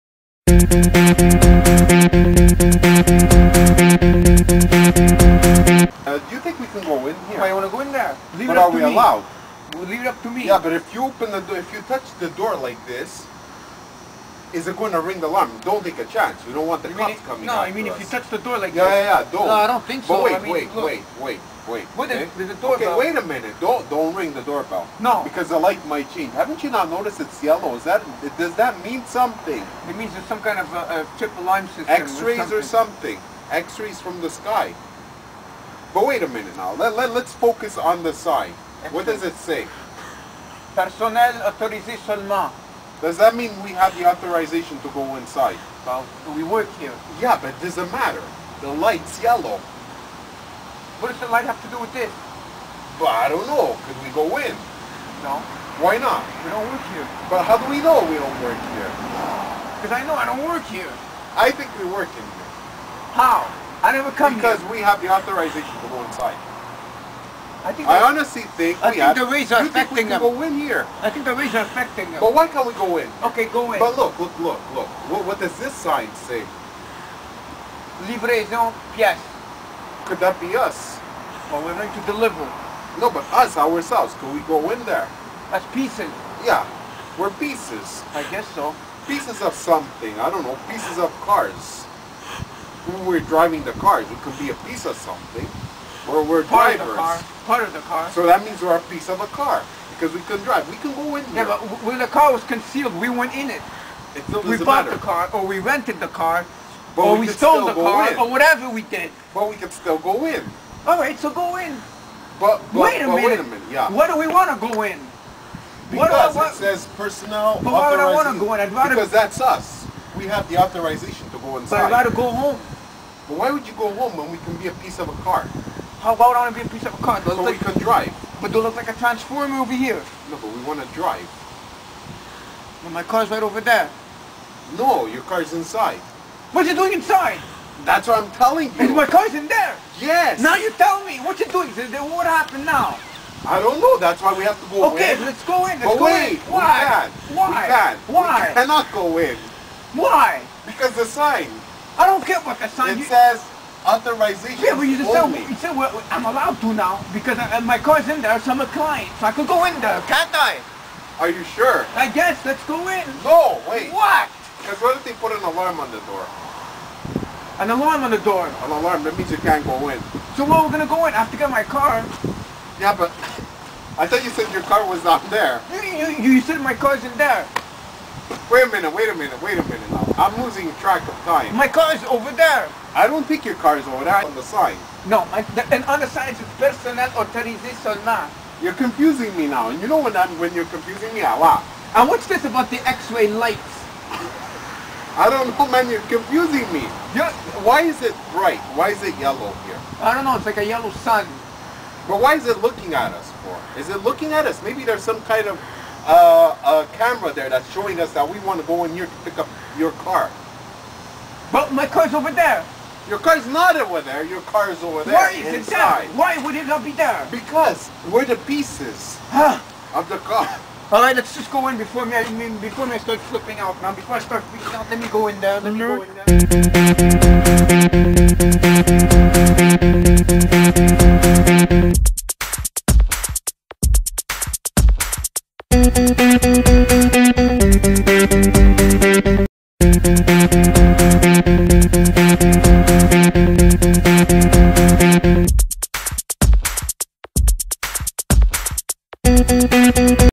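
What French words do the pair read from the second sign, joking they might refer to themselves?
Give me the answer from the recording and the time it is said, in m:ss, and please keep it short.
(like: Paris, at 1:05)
Livraison pièce, at 1:18.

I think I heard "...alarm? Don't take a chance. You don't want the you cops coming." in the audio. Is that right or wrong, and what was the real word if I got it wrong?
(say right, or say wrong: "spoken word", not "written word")
right.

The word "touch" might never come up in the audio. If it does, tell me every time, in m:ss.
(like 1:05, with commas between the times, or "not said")
0:11, 0:18.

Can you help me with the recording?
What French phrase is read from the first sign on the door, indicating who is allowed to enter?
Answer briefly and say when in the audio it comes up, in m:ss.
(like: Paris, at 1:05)
Personnel autorisé seulement, at 0:40.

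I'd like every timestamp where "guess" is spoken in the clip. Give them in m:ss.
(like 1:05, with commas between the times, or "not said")
1:28, 2:42.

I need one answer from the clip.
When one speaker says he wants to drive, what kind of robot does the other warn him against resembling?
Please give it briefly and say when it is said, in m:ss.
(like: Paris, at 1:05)
transformer, at 2:08.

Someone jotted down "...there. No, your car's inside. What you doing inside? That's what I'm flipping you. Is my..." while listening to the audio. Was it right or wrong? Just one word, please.
wrong.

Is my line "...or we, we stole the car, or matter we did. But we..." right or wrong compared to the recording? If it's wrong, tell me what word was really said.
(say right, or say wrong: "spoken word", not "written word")
wrong: "whatever", not "matter".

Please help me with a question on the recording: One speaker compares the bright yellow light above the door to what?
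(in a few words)
a yellow sun.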